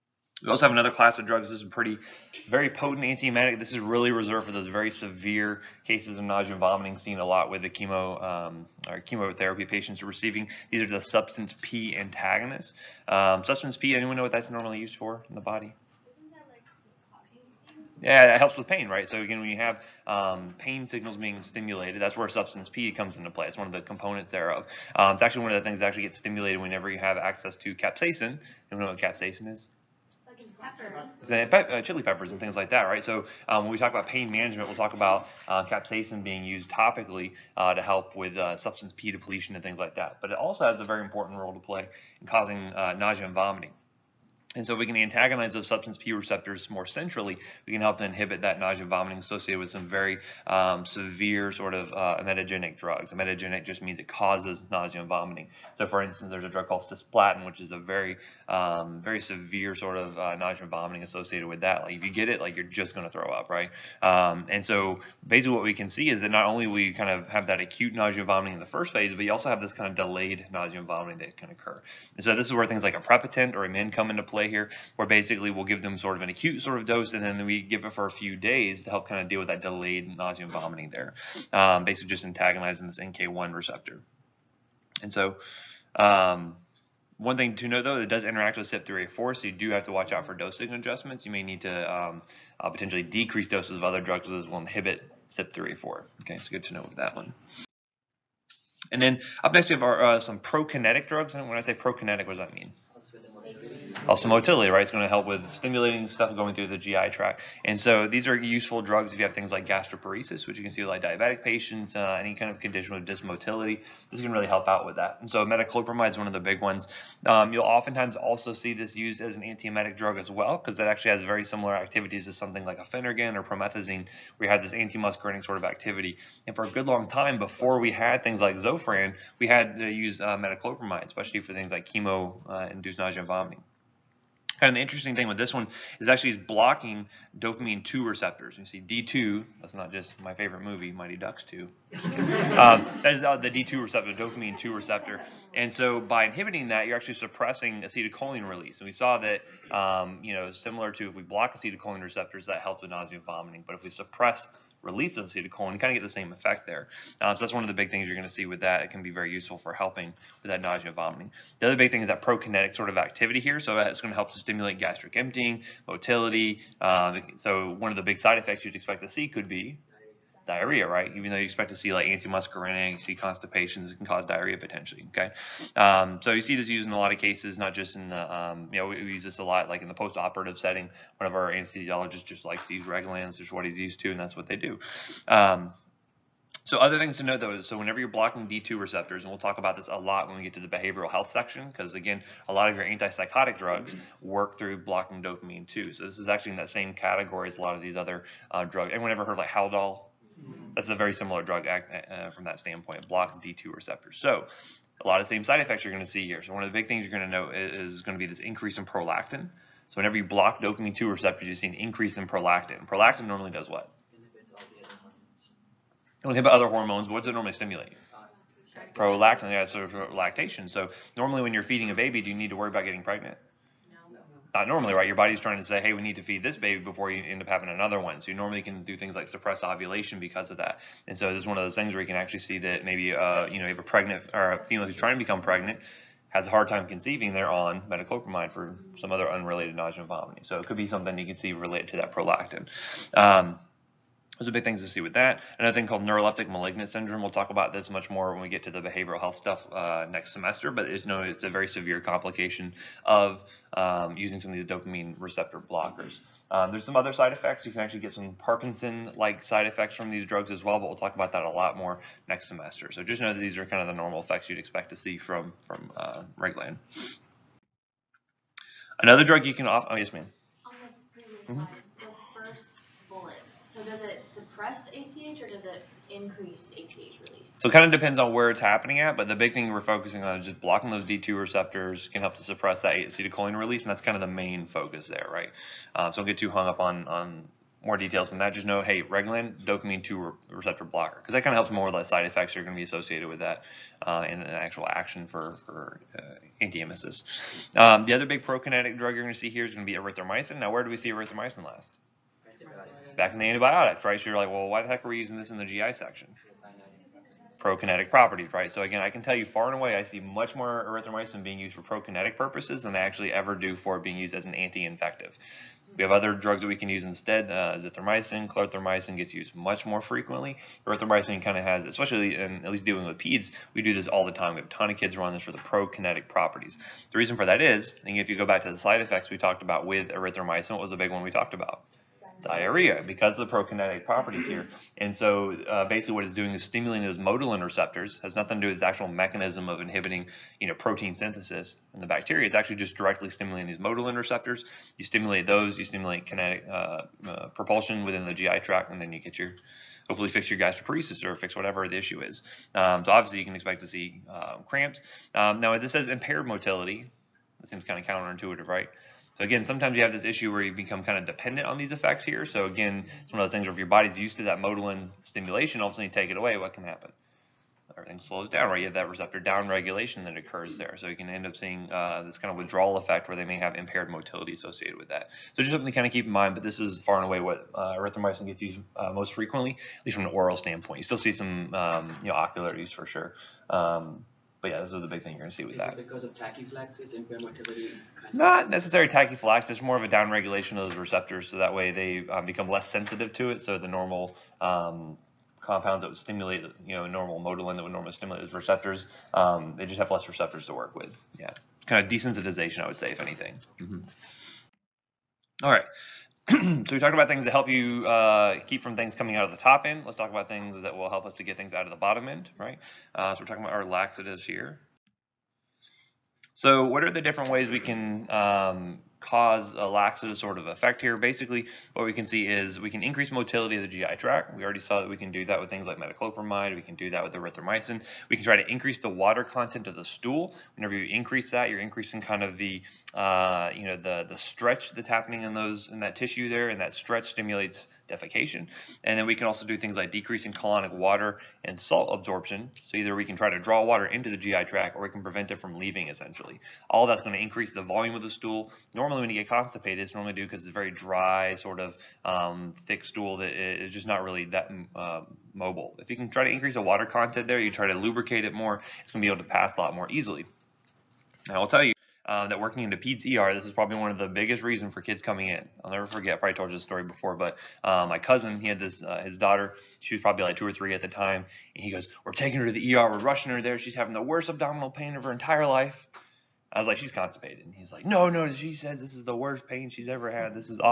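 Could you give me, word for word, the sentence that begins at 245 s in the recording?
Another thing called neuroleptic malignant syndrome.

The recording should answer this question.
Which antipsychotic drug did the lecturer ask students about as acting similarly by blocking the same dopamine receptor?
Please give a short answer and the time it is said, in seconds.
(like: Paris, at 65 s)
Haldol, at 199 s.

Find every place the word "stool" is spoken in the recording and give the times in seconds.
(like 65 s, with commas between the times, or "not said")
430 s, 448 s, 453 s.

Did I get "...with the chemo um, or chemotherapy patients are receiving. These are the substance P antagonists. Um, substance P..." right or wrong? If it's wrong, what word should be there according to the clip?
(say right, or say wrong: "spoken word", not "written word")
right.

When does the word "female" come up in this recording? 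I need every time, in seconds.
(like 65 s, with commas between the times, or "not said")
234 s.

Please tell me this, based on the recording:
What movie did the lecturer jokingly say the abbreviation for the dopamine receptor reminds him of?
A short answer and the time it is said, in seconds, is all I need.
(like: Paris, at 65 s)
Mighty Ducks 2, at 140 s.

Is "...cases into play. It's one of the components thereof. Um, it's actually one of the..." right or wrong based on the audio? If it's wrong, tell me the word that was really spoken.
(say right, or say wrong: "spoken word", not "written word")
wrong: "comes", not "cases".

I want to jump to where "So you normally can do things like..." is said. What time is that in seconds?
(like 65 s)
228 s.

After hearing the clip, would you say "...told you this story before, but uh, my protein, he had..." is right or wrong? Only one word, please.
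wrong.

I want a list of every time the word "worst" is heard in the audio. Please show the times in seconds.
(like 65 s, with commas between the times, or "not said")
474 s, 479 s.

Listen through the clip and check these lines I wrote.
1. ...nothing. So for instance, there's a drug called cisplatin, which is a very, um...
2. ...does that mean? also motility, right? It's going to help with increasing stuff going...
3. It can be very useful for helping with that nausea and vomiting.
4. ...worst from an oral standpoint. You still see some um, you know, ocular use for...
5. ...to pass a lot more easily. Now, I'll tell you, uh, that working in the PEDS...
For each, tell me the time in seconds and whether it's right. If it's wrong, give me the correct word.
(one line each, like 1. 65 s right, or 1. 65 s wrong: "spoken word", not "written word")
1. 55 s wrong: "vomiting", not "nothing"
2. 102 s wrong: "stimulating", not "increasing"
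3. 158 s right
4. 380 s wrong: "least", not "worst"
5. 459 s right.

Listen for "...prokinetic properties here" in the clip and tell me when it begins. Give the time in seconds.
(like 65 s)
333 s.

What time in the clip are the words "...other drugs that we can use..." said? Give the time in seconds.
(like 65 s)
316 s.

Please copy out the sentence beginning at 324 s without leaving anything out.
We have a ton of kids who this for the prokinetic properties.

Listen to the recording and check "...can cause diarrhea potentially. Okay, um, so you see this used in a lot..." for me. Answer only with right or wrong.
right.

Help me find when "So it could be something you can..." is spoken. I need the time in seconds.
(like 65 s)
240 s.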